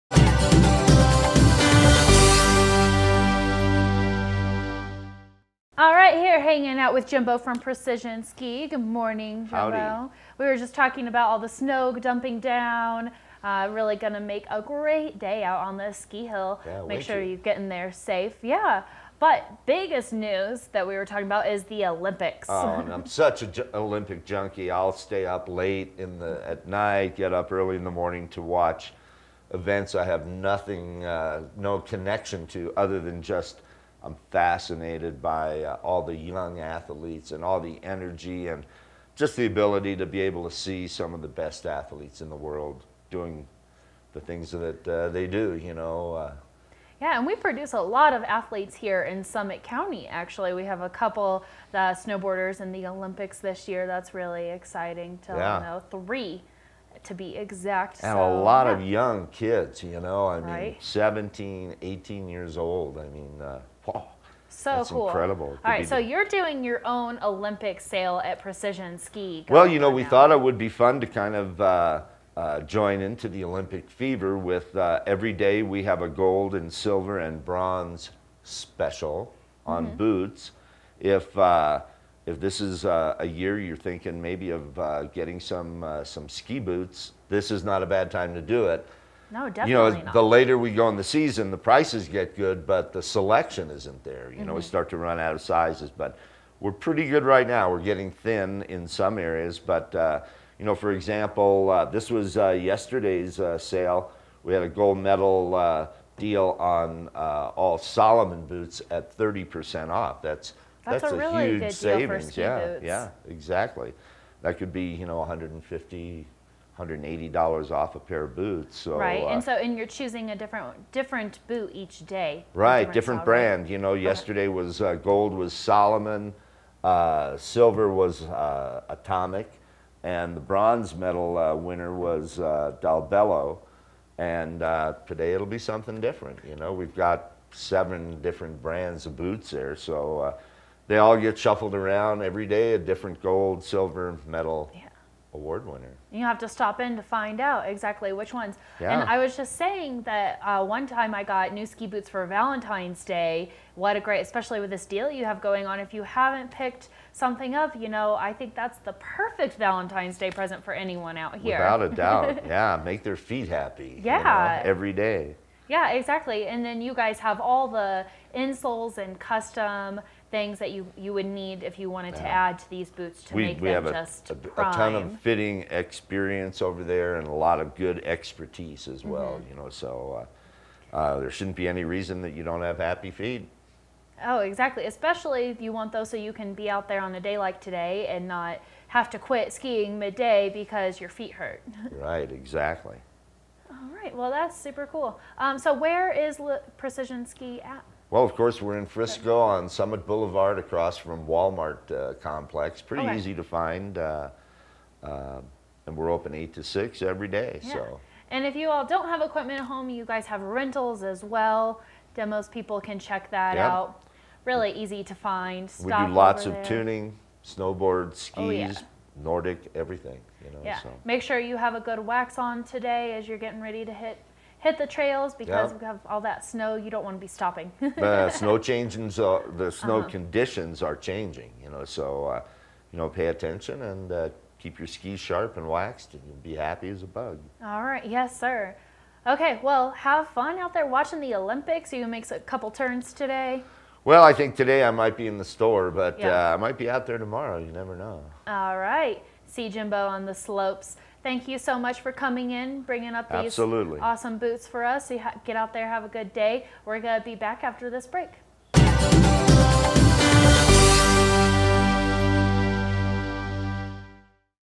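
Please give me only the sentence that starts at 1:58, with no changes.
So, right, and uh, so and you're choosing a different different boot each day.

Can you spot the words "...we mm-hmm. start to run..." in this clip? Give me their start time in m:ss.
1:34.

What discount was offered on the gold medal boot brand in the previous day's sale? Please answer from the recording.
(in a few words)
30%.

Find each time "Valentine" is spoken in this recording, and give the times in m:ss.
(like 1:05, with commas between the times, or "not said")
2:32, 2:39.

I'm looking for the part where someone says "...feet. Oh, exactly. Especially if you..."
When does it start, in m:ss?
3:03.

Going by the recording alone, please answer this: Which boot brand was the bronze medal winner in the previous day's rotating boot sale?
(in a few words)
Dalbello.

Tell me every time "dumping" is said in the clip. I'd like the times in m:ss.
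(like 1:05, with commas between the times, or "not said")
0:11.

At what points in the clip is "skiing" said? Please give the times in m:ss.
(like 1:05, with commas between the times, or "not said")
3:09.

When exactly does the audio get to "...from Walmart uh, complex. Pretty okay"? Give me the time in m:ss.
3:20.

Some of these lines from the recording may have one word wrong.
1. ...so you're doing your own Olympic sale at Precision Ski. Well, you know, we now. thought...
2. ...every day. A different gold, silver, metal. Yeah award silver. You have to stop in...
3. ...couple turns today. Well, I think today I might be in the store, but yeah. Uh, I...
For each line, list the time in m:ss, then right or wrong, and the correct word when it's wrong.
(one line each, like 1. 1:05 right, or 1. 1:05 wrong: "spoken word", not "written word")
1. 1:05 right
2. 2:22 wrong: "winner", not "silver"
3. 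4:02 right.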